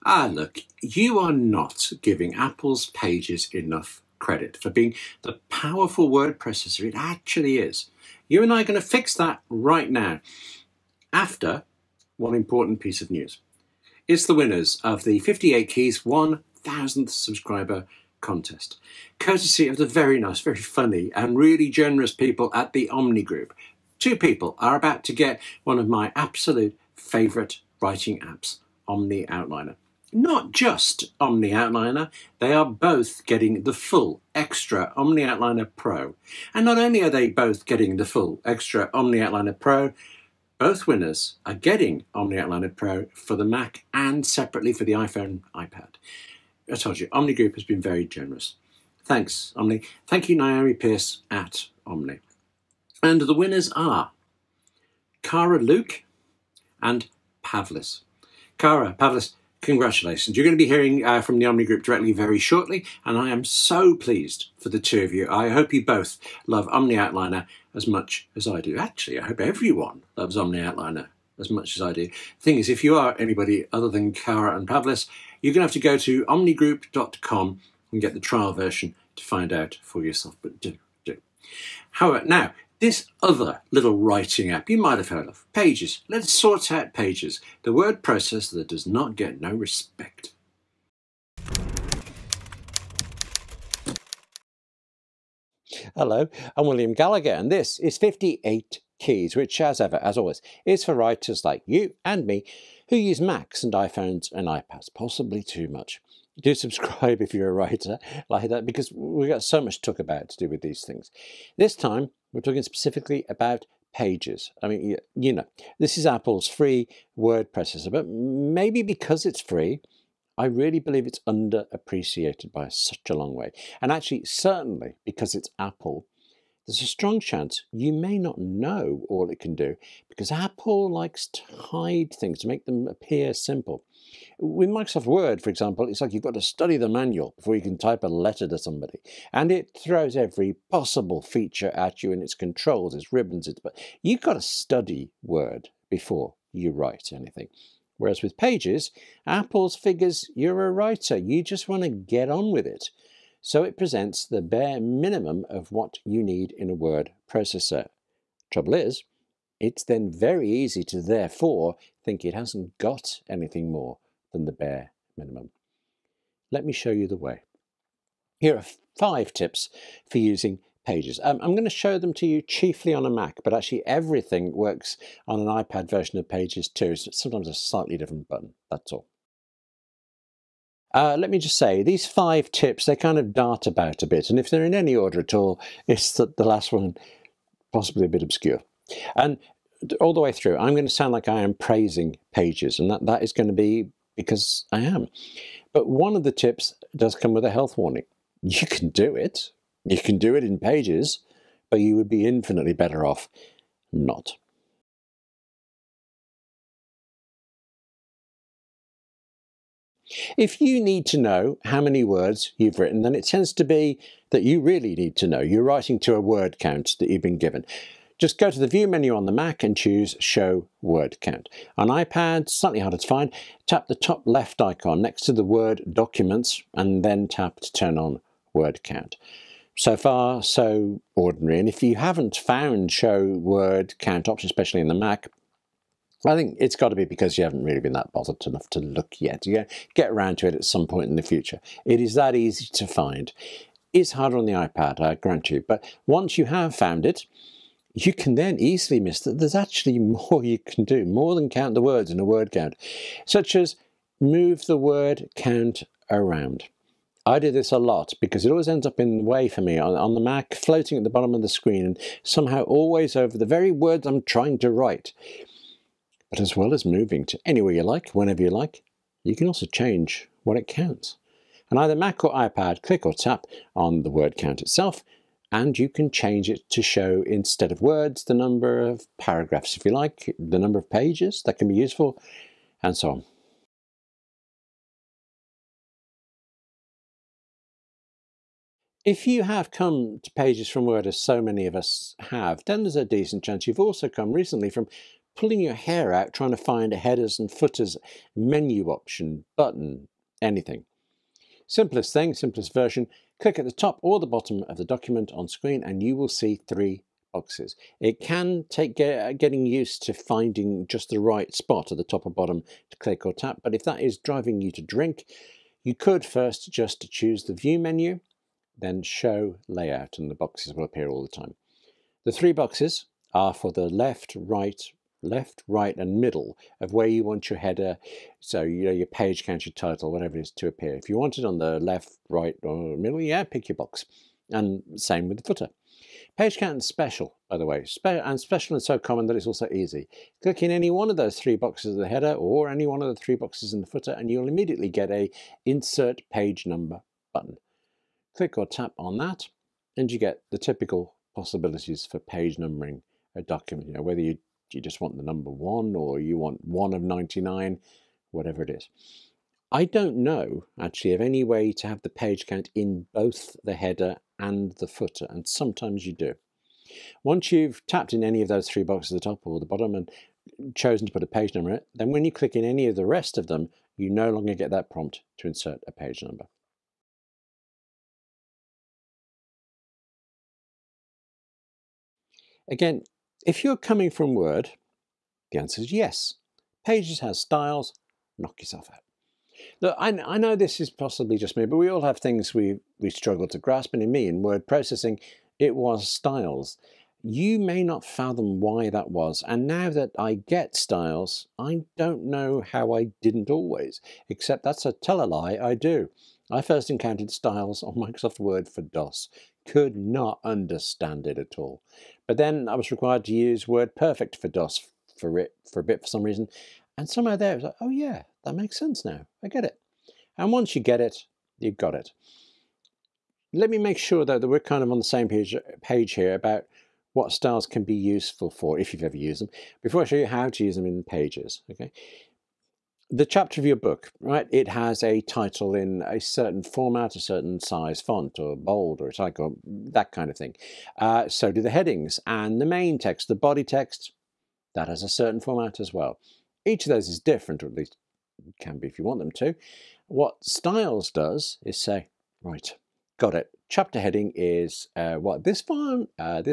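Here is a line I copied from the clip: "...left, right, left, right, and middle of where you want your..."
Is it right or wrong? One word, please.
right.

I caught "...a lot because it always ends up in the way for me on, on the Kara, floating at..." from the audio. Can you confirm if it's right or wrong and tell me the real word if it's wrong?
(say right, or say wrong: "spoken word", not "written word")
wrong: "Mac", not "Kara".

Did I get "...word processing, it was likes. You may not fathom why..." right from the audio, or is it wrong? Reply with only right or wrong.
wrong.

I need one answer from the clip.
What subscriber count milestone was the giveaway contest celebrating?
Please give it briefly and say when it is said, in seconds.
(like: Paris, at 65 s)
1000th, at 16 s.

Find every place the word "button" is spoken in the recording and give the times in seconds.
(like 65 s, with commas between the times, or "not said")
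178 s, 299 s, 347 s.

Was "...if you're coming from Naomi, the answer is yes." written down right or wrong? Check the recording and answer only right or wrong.
wrong.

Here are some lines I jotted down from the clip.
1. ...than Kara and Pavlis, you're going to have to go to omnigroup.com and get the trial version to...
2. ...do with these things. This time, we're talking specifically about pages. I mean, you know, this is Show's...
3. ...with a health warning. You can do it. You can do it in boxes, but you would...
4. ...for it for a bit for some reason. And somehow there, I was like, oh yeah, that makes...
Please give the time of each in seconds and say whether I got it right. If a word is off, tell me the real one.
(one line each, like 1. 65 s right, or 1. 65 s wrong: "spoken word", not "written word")
1. 73 s right
2. 110 s wrong: "Apple", not "Show"
3. 197 s wrong: "pages", not "boxes"
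4. 415 s right.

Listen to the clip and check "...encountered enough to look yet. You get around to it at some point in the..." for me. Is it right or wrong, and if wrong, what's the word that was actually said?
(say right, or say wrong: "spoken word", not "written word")
wrong: "bothered", not "encountered".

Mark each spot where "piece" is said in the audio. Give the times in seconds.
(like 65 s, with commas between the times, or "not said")
12 s.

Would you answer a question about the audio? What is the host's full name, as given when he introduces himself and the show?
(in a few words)
William Gallagher.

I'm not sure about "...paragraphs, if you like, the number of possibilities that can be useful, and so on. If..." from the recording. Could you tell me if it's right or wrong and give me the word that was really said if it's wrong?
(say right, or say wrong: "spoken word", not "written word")
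wrong: "pages", not "possibilities".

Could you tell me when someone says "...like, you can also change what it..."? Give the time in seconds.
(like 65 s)
268 s.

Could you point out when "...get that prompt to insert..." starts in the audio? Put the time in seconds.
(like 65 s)
374 s.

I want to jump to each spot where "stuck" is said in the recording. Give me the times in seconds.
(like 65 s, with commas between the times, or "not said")
not said.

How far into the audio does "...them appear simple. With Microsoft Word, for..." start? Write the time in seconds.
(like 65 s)
132 s.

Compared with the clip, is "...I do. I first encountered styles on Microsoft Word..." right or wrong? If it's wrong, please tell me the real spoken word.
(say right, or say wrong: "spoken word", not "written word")
right.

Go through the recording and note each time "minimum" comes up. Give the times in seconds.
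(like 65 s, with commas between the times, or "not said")
154 s, 165 s.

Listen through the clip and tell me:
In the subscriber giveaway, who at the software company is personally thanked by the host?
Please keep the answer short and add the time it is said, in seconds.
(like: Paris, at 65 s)
Naomi Pierce, at 50 s.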